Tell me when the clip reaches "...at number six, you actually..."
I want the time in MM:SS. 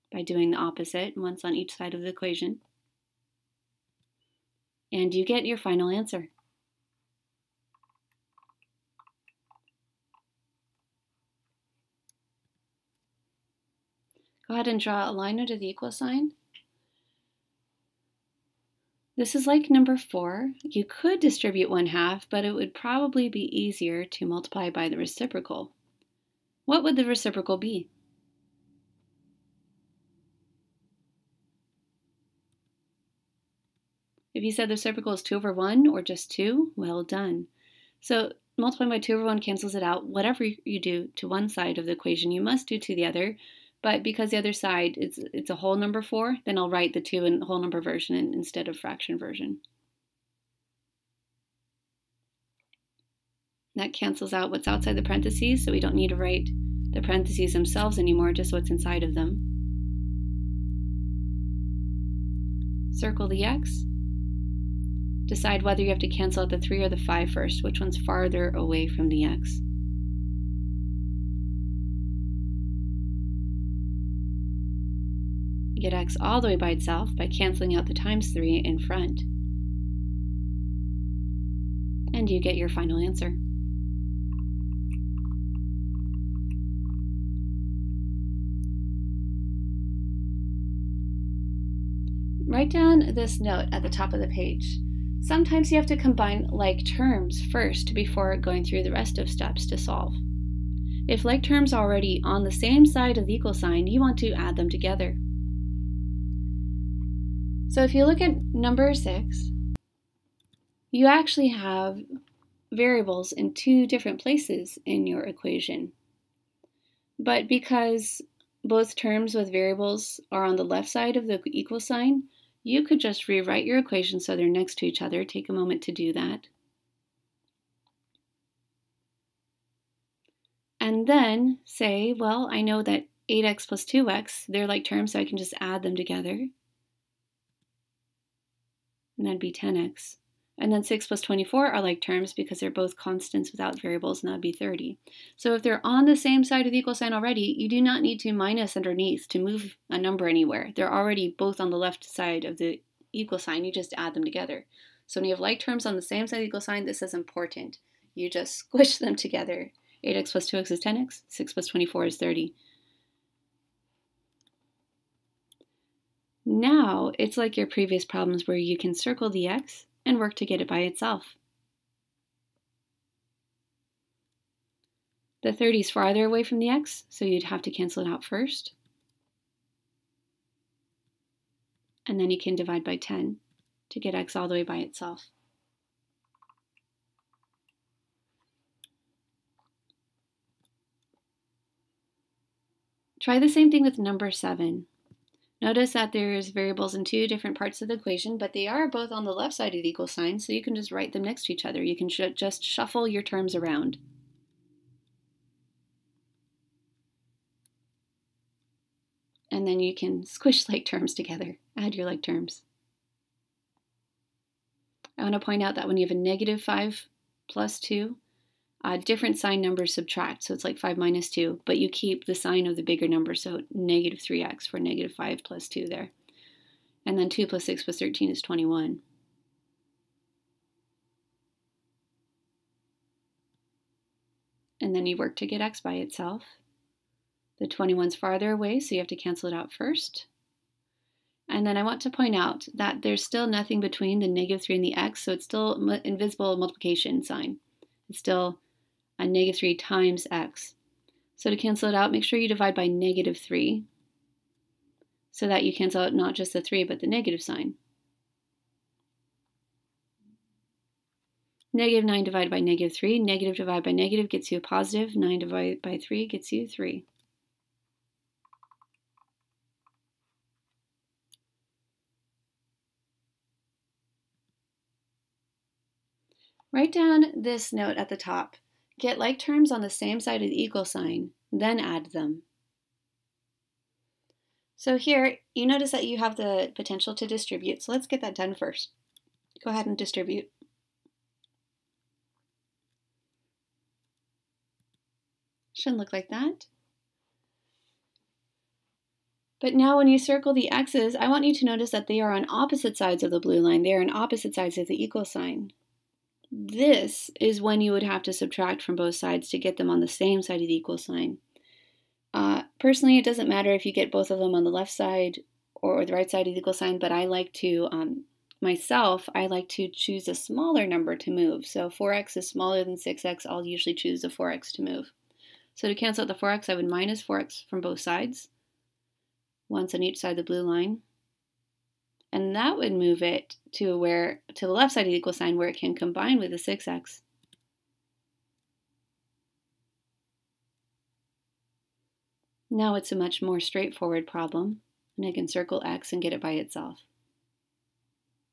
01:48.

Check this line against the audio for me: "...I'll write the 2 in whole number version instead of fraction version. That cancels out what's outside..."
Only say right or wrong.
right.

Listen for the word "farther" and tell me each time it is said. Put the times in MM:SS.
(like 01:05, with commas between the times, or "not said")
01:07, 02:55, 03:58.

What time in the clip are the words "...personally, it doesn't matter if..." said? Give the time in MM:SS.
05:12.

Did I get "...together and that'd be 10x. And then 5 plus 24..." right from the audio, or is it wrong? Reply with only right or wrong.
wrong.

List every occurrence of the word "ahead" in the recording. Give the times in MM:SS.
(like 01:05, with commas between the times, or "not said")
00:14, 04:49.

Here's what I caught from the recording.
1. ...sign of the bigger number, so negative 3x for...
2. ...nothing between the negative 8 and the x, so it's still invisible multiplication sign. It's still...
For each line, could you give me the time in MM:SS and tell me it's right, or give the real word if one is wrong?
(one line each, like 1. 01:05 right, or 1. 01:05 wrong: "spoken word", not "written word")
1. 03:42 right
2. 04:03 wrong: "3", not "8".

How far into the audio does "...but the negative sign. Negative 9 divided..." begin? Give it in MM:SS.
04:16.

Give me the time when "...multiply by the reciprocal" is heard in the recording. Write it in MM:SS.
00:24.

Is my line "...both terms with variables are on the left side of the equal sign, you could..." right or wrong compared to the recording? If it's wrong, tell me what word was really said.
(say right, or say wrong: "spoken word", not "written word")
right.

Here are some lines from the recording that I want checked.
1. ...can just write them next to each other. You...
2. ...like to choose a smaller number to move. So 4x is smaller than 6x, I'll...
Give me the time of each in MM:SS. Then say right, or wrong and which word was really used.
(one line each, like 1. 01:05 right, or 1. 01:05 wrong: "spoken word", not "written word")
1. 03:20 right
2. 05:19 right.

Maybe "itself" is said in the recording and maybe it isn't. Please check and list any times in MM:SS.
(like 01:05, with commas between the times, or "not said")
01:16, 02:50, 03:04, 03:55, 05:46.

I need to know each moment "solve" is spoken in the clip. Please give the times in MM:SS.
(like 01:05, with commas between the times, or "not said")
01:39.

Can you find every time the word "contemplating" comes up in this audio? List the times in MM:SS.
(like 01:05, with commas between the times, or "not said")
not said.